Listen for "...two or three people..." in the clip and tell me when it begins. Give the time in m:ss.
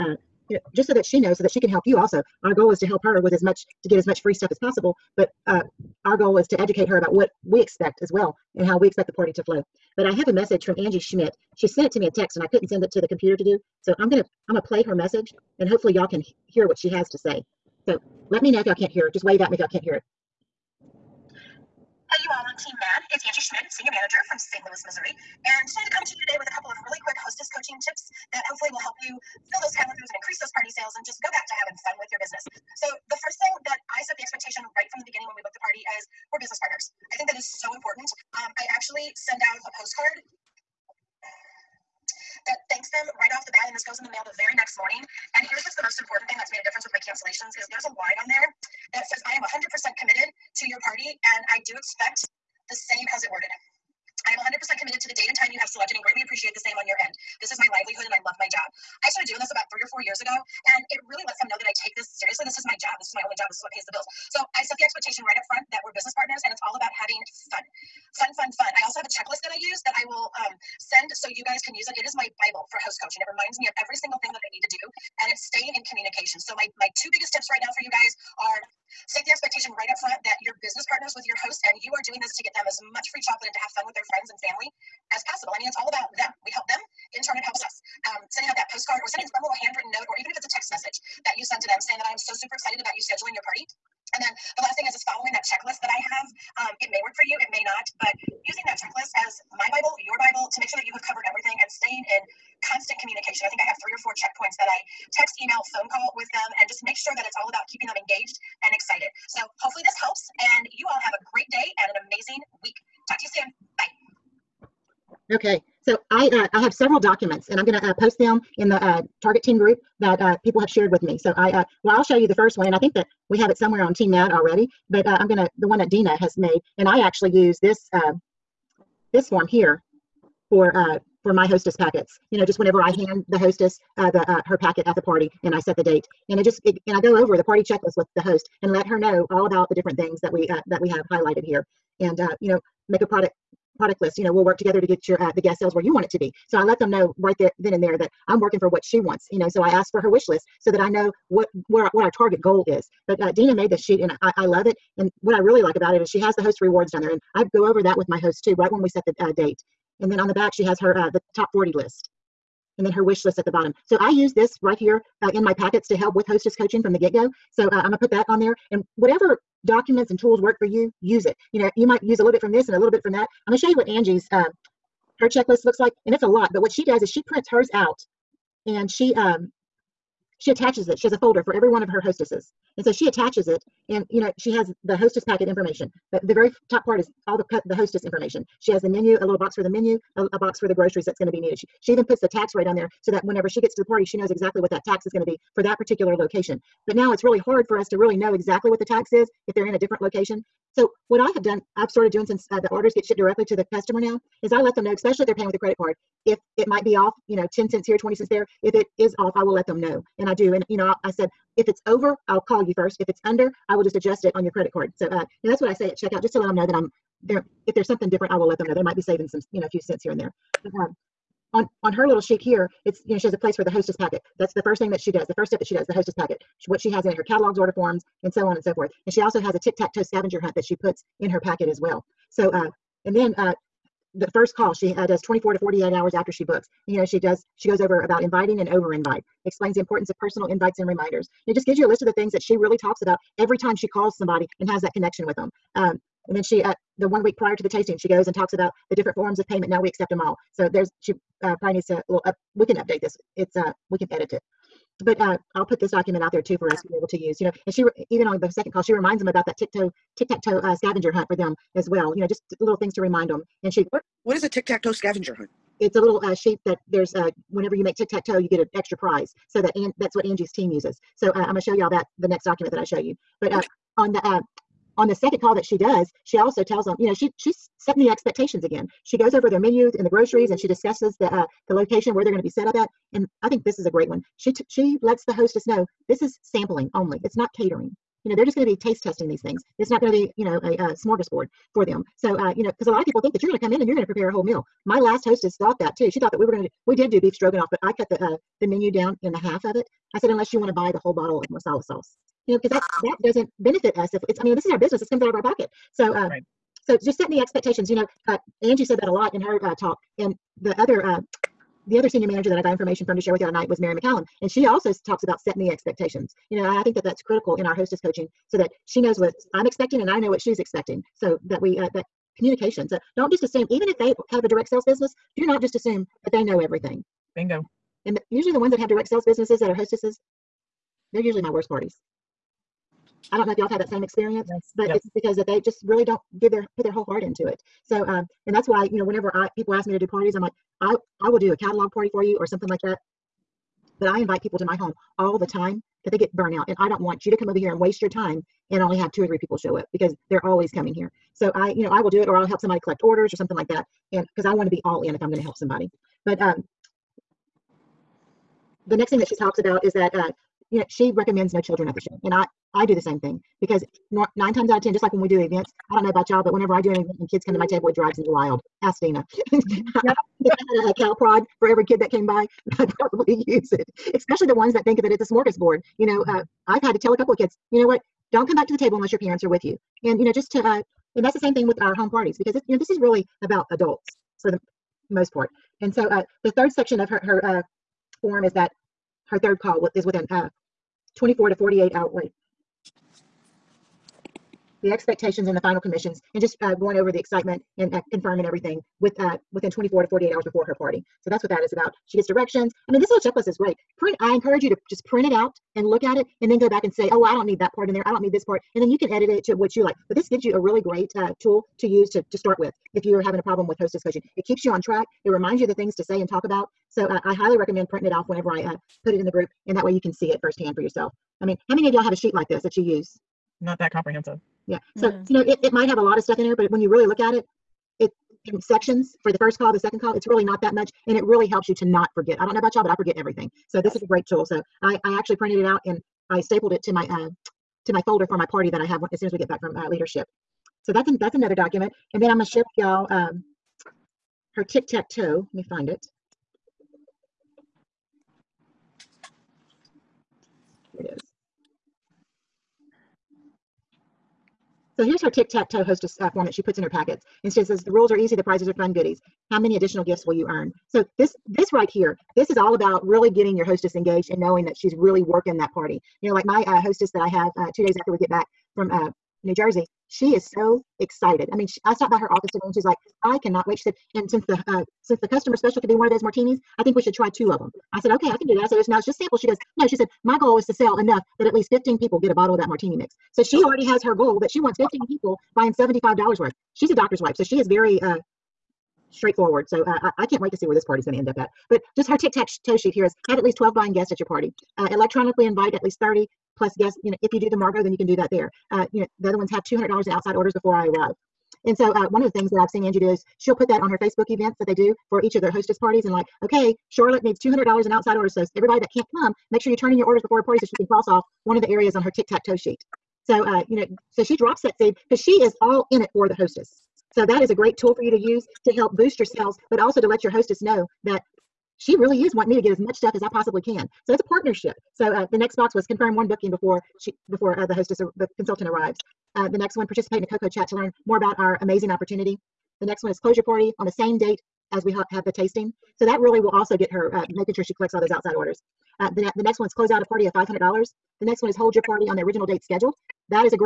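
5:49.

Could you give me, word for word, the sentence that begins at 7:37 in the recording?
And she says, the rules are easy, the prizes are fun goodies.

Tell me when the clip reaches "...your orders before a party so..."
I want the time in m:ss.
8:29.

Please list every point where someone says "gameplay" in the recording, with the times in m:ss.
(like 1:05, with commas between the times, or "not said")
not said.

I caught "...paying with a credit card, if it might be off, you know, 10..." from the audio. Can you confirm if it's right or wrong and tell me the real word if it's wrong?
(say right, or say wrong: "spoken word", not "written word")
right.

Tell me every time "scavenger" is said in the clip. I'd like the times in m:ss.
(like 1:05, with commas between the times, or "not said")
3:50, 4:20, 4:24.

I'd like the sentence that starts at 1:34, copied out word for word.
And then the last thing is is following that checklist that I have.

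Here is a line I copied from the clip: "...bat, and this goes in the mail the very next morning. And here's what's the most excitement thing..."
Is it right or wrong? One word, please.
wrong.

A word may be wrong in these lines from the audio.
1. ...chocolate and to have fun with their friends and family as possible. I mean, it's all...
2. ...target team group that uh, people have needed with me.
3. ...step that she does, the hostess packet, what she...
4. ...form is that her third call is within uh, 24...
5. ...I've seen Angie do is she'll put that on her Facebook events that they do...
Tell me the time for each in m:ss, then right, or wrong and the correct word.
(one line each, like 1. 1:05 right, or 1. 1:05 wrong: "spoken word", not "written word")
1. 1:23 right
2. 1:59 wrong: "shared", not "needed"
3. 3:45 right
4. 6:28 right
5. 8:22 right.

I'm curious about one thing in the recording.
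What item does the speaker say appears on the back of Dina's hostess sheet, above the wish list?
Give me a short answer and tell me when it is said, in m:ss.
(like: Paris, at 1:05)
Top 40 list, at 2:41.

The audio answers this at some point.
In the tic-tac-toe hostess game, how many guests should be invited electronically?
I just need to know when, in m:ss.
8:16.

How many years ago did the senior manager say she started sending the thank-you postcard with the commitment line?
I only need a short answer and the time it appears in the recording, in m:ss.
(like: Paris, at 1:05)
3 or 4, at 0:59.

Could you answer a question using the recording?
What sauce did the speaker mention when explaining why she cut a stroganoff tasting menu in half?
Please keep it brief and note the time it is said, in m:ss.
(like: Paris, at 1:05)
Marsala sauce, at 5:01.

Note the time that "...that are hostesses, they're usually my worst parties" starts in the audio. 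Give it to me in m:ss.
5:29.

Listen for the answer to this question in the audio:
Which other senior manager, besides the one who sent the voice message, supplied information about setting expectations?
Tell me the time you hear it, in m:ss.
5:13.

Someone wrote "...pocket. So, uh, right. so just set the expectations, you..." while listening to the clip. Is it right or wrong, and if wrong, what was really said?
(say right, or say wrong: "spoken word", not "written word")
right.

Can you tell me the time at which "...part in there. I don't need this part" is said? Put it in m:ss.
6:47.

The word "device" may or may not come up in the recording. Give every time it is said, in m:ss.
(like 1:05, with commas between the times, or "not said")
not said.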